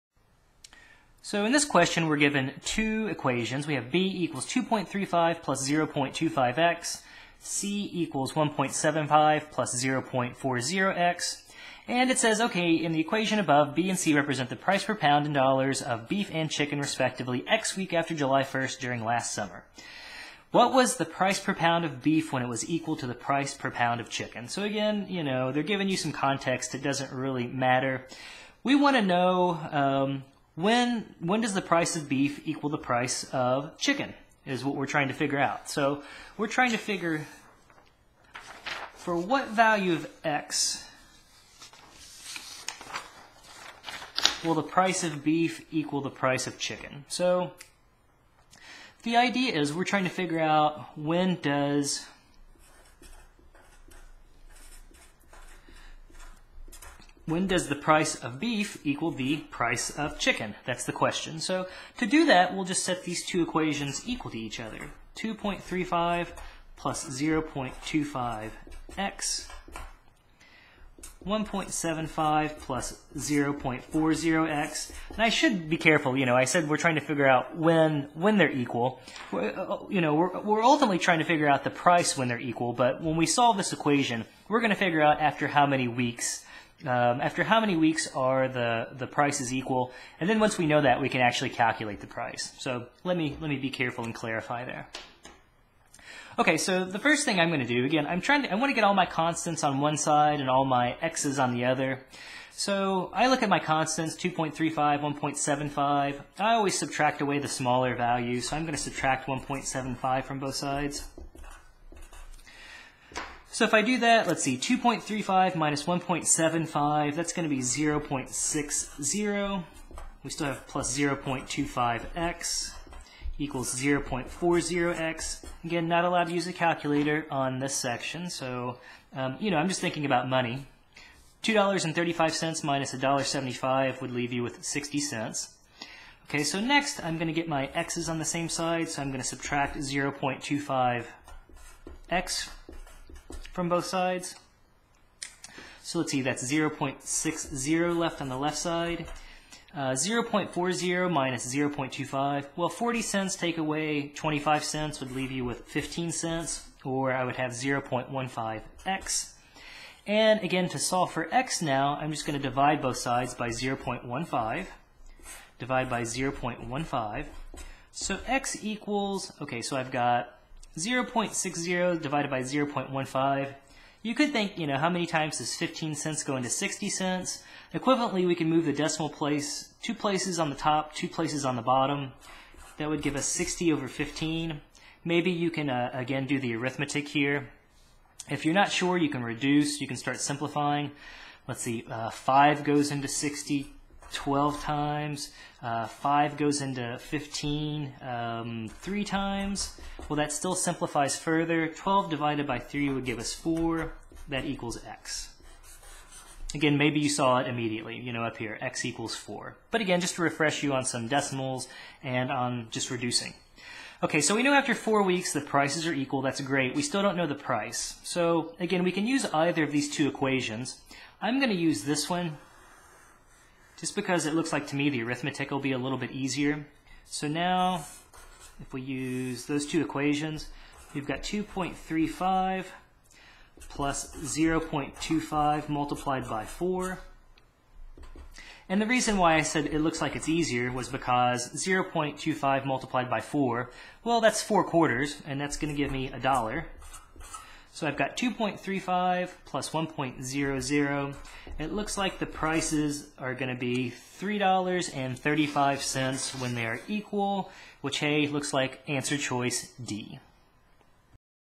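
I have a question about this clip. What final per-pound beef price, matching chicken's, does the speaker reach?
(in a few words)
$3.35.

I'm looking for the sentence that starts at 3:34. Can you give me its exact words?
Okay, so we know after four weeks the prices are equal.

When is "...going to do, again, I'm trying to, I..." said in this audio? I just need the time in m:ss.
1:37.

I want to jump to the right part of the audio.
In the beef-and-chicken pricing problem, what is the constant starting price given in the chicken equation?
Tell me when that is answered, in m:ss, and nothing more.
0:07.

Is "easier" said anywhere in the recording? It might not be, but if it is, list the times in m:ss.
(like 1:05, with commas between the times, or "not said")
3:46, 4:00.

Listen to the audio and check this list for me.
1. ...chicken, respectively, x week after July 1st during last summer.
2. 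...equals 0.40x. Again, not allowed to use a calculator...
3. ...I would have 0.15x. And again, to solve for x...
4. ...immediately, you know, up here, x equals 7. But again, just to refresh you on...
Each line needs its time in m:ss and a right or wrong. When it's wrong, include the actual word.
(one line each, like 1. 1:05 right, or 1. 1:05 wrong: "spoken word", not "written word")
1. 0:16 right
2. 2:03 right
3. 2:37 right
4. 3:27 wrong: "4", not "7".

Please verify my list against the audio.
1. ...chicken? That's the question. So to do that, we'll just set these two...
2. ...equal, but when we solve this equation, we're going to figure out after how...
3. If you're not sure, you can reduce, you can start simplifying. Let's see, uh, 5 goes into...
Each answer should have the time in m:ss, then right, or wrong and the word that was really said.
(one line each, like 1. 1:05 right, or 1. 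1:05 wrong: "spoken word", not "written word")
1. 1:00 right
2. 1:22 right
3. 3:08 right.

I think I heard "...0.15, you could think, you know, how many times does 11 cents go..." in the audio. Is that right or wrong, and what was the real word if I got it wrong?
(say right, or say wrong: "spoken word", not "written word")
wrong: "15", not "11".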